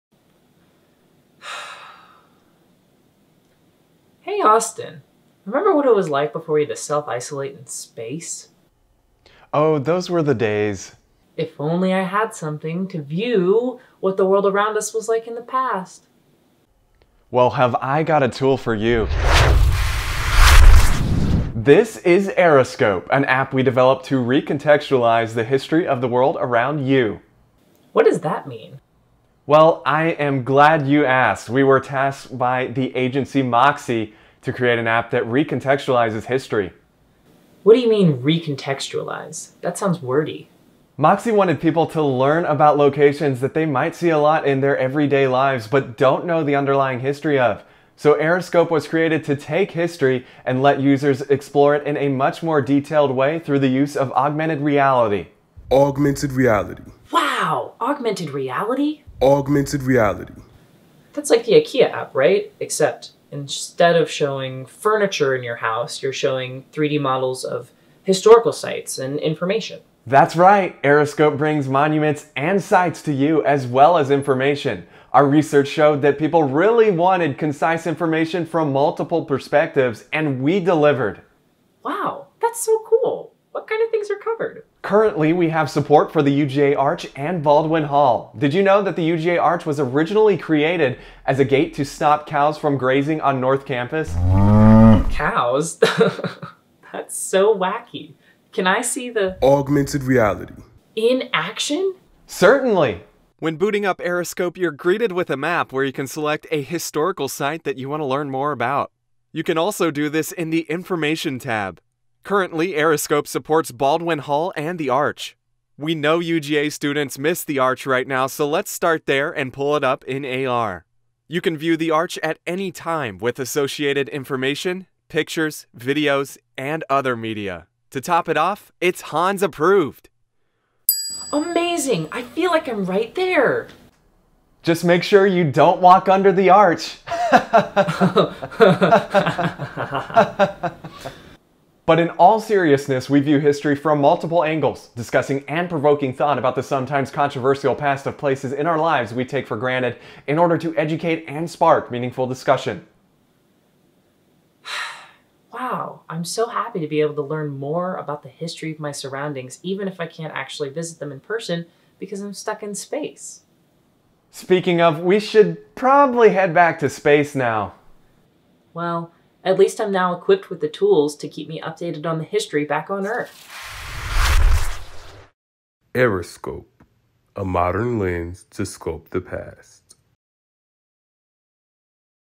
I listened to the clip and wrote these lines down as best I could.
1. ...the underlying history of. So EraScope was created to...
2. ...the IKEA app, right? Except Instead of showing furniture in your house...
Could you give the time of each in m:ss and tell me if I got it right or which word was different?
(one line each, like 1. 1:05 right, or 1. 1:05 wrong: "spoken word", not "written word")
1. 0:46 right
2. 1:01 right.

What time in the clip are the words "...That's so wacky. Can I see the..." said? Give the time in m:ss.
1:36.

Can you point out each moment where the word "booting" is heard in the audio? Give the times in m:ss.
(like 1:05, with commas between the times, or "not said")
1:43.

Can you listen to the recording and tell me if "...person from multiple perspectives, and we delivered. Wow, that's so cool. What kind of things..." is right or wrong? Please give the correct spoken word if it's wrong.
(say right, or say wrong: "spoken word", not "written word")
wrong: "information", not "person".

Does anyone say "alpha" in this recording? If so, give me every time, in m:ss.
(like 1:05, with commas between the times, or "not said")
not said.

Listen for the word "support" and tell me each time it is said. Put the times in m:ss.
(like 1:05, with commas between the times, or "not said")
1:25, 1:53.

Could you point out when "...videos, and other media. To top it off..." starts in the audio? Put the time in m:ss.
2:05.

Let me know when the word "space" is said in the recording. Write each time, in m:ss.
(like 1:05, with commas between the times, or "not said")
0:07, 2:42, 2:46.